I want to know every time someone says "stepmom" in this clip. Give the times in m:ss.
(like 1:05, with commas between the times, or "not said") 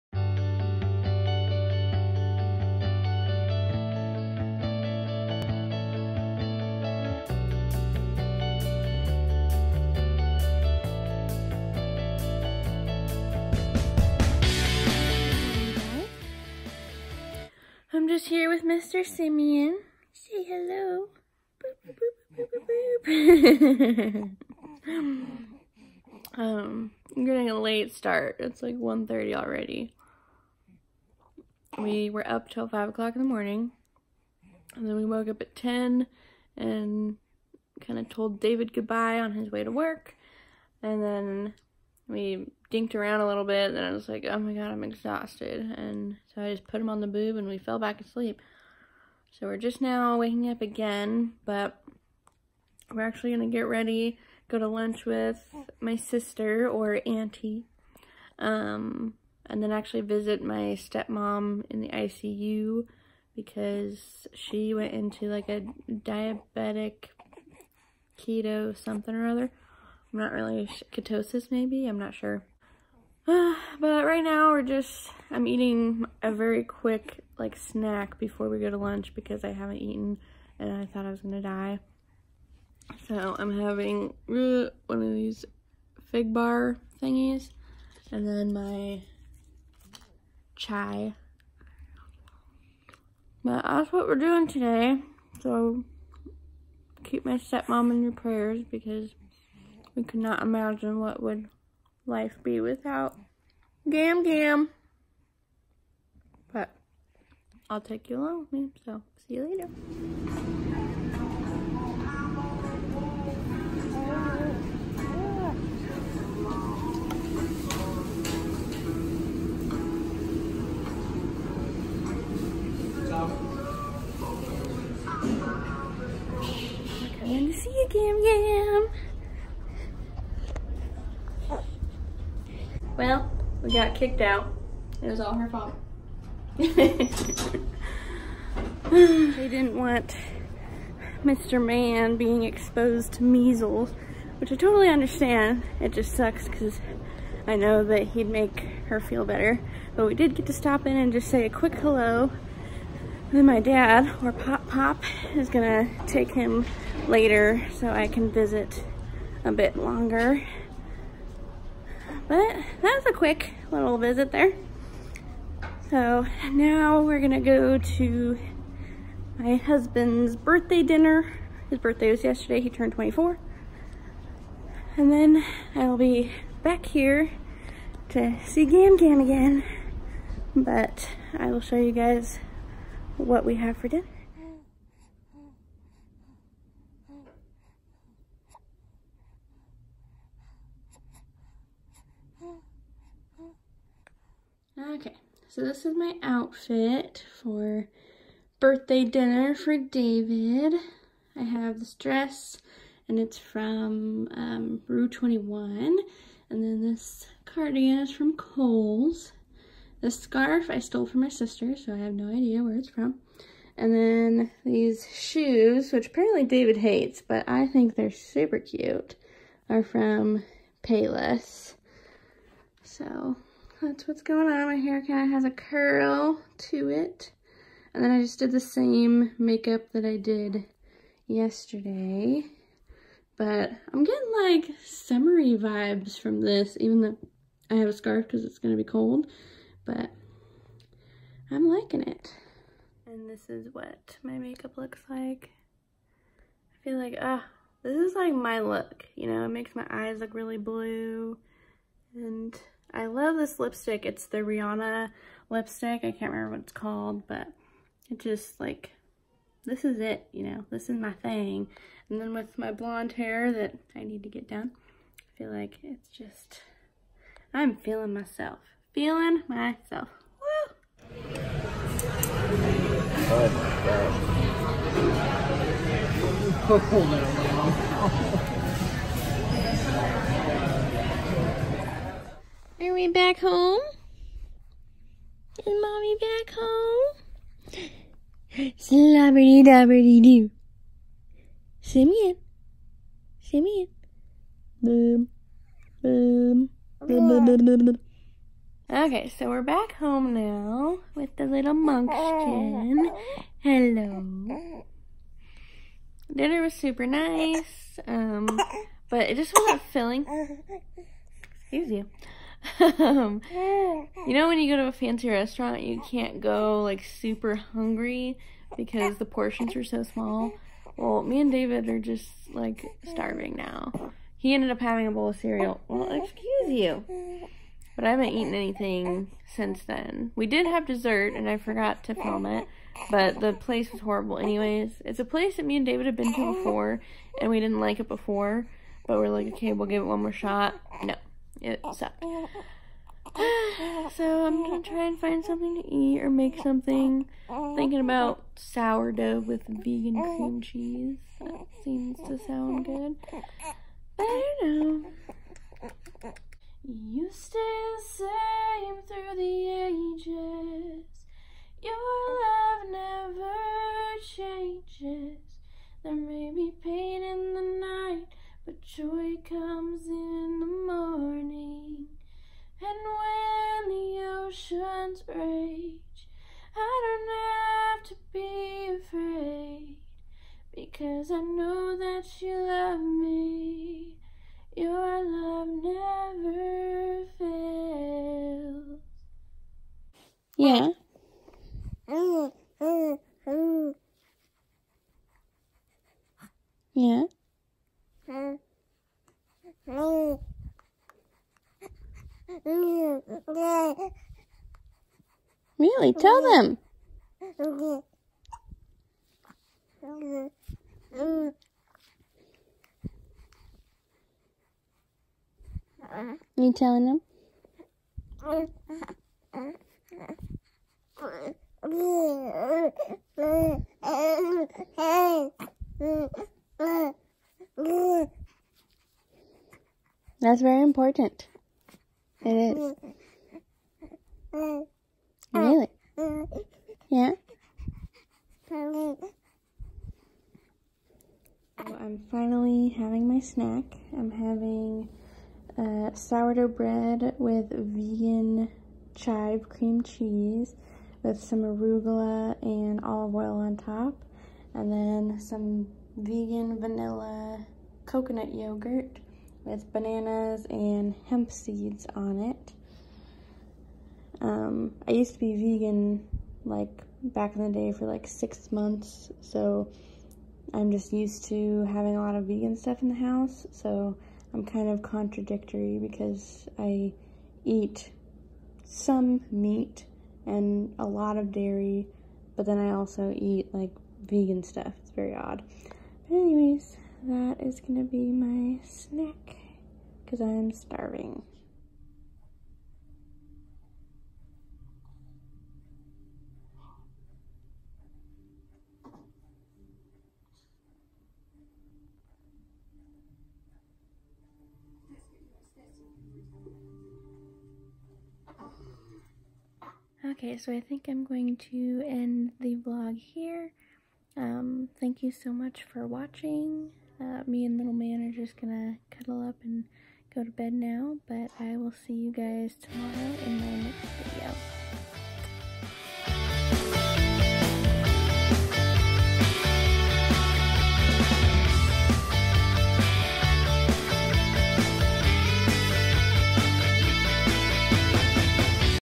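1:00, 1:37.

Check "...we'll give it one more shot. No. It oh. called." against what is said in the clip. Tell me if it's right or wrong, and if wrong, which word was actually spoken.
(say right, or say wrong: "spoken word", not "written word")
wrong: "sucked", not "called".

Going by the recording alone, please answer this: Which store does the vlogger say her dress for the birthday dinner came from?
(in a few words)
Rue 21.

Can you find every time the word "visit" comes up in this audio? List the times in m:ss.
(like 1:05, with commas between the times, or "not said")
1:00, 2:38, 2:43.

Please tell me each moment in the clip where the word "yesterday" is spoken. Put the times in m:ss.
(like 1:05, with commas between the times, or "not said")
2:52, 3:51.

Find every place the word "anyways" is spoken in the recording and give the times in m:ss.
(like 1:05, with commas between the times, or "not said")
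5:34, 8:06.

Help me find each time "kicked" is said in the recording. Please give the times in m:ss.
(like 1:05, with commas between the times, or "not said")
2:13.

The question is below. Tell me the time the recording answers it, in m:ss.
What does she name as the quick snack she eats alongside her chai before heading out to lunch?
1:26.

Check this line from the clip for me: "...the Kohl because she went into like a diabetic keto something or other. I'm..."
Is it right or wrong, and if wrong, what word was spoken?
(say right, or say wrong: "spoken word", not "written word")
wrong: "ICU", not "Kohl".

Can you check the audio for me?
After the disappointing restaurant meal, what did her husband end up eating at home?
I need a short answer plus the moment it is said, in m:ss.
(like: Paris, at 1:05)
bowl of cereal, at 5:25.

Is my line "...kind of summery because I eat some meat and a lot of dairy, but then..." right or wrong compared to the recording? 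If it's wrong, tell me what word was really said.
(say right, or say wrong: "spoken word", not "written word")
wrong: "contradictory", not "summery".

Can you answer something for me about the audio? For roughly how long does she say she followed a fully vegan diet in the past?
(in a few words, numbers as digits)
6 months.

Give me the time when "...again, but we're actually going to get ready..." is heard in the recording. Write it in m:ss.
0:50.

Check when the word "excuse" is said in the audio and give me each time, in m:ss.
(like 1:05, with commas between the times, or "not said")
5:11, 5:26.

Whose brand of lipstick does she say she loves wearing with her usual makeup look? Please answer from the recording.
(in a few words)
Rihanna.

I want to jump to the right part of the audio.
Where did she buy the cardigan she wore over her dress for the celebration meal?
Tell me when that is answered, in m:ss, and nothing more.
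3:28.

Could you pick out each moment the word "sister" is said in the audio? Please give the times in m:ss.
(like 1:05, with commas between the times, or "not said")
0:55, 3:31.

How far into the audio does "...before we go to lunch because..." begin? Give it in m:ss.
1:18.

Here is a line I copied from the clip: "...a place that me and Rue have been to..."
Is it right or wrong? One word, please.
wrong.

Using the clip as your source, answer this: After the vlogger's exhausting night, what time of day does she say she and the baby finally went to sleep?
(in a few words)
5 o'clock.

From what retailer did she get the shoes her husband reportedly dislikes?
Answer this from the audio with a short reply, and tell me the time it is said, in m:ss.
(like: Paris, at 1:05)
Payless, at 3:40.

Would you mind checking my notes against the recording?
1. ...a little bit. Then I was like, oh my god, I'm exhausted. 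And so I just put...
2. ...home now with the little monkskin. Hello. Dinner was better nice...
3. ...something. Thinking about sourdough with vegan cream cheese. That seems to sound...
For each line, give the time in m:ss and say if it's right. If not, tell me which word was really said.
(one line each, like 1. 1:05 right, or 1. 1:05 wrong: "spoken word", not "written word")
1. 0:43 right
2. 4:59 wrong: "super", not "better"
3. 5:46 right.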